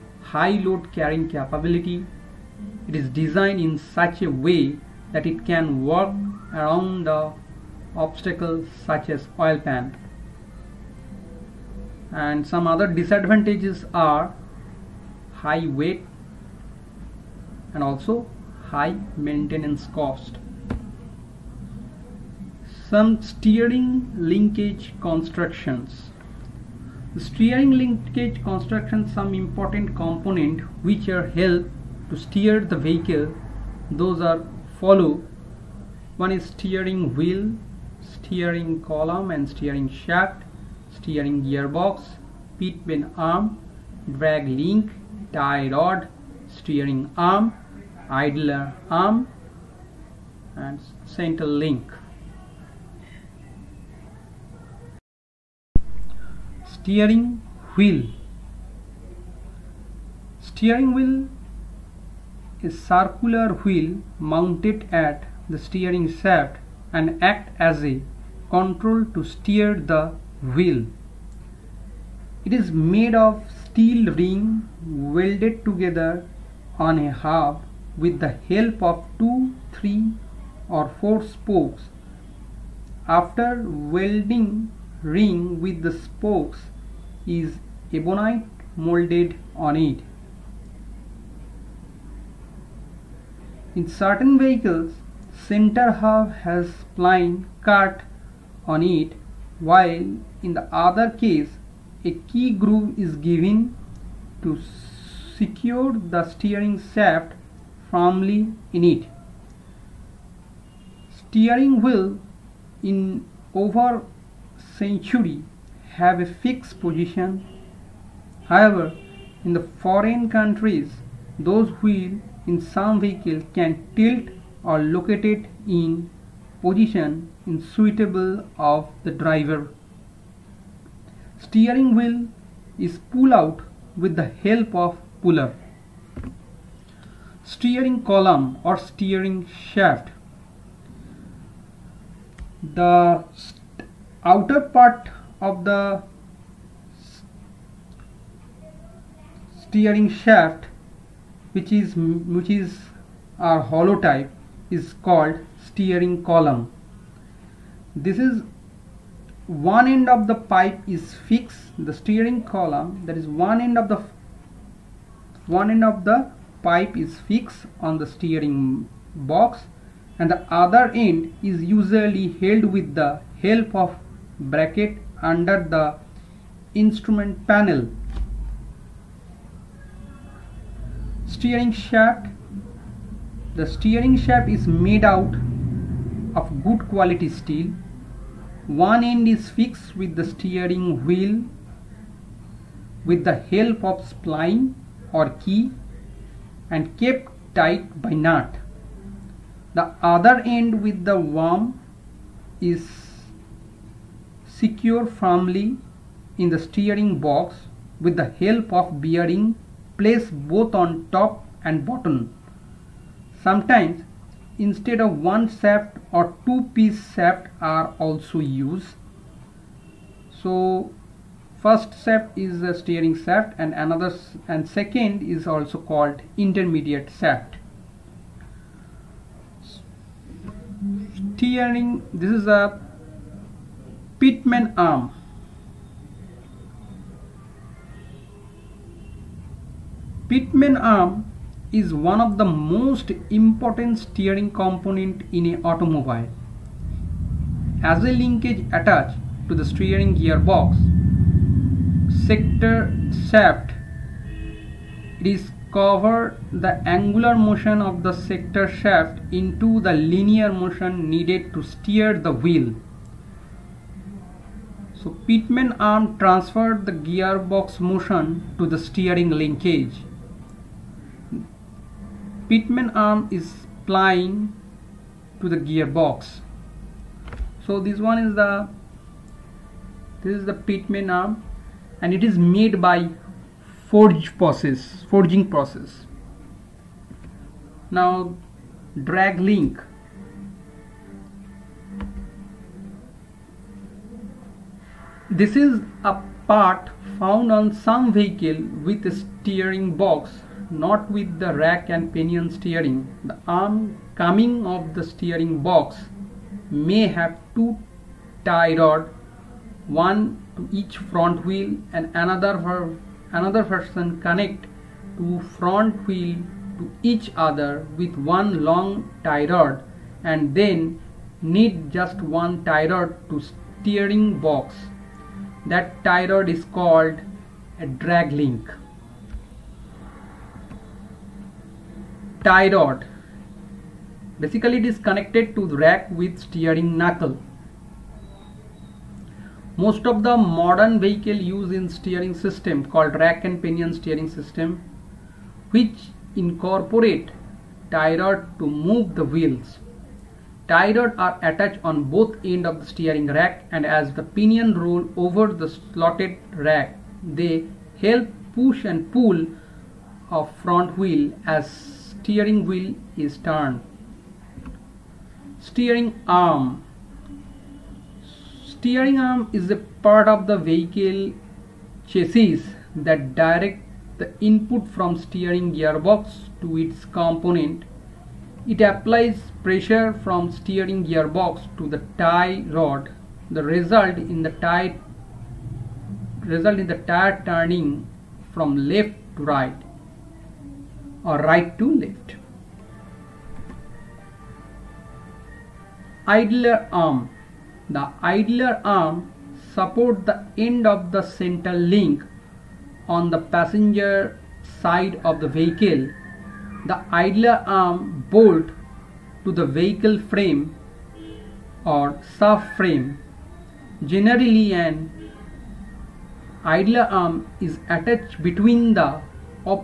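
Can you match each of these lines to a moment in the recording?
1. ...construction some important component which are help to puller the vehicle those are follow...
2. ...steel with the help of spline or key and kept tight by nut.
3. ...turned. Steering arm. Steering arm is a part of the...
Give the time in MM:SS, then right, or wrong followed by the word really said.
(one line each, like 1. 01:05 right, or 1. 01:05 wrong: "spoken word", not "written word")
1. 00:28 wrong: "steer", not "puller"
2. 03:11 wrong: "wheel", not "steel"
3. 06:03 right.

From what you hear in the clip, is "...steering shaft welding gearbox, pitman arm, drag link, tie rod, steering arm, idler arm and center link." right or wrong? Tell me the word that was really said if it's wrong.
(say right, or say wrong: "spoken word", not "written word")
wrong: "steering", not "welding".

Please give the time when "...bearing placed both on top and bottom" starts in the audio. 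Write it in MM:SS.
03:29.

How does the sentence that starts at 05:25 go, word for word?
That tie rod is called a drag link.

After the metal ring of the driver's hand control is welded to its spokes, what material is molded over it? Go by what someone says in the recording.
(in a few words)
Ebonite.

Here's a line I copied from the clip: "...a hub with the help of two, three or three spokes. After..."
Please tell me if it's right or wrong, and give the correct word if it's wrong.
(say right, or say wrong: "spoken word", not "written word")
wrong: "four", not "three".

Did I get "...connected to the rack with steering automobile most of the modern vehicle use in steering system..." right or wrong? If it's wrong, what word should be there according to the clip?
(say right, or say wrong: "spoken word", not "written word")
wrong: "knuckle", not "automobile".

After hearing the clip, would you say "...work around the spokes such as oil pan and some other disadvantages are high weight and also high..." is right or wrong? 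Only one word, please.
wrong.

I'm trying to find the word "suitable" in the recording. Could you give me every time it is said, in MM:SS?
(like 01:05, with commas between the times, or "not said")
02:07.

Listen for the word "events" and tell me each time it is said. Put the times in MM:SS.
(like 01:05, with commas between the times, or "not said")
not said.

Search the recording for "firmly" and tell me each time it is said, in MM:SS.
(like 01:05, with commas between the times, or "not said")
01:47, 03:25.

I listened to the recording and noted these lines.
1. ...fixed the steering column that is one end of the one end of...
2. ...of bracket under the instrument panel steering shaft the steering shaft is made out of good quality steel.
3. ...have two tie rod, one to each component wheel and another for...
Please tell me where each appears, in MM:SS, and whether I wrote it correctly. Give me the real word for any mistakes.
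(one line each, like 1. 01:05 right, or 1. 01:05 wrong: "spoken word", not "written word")
1. 02:41 right
2. 02:53 right
3. 05:07 wrong: "front", not "component".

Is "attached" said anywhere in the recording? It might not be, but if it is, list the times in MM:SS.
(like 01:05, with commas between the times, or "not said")
04:08, 05:51, 06:57.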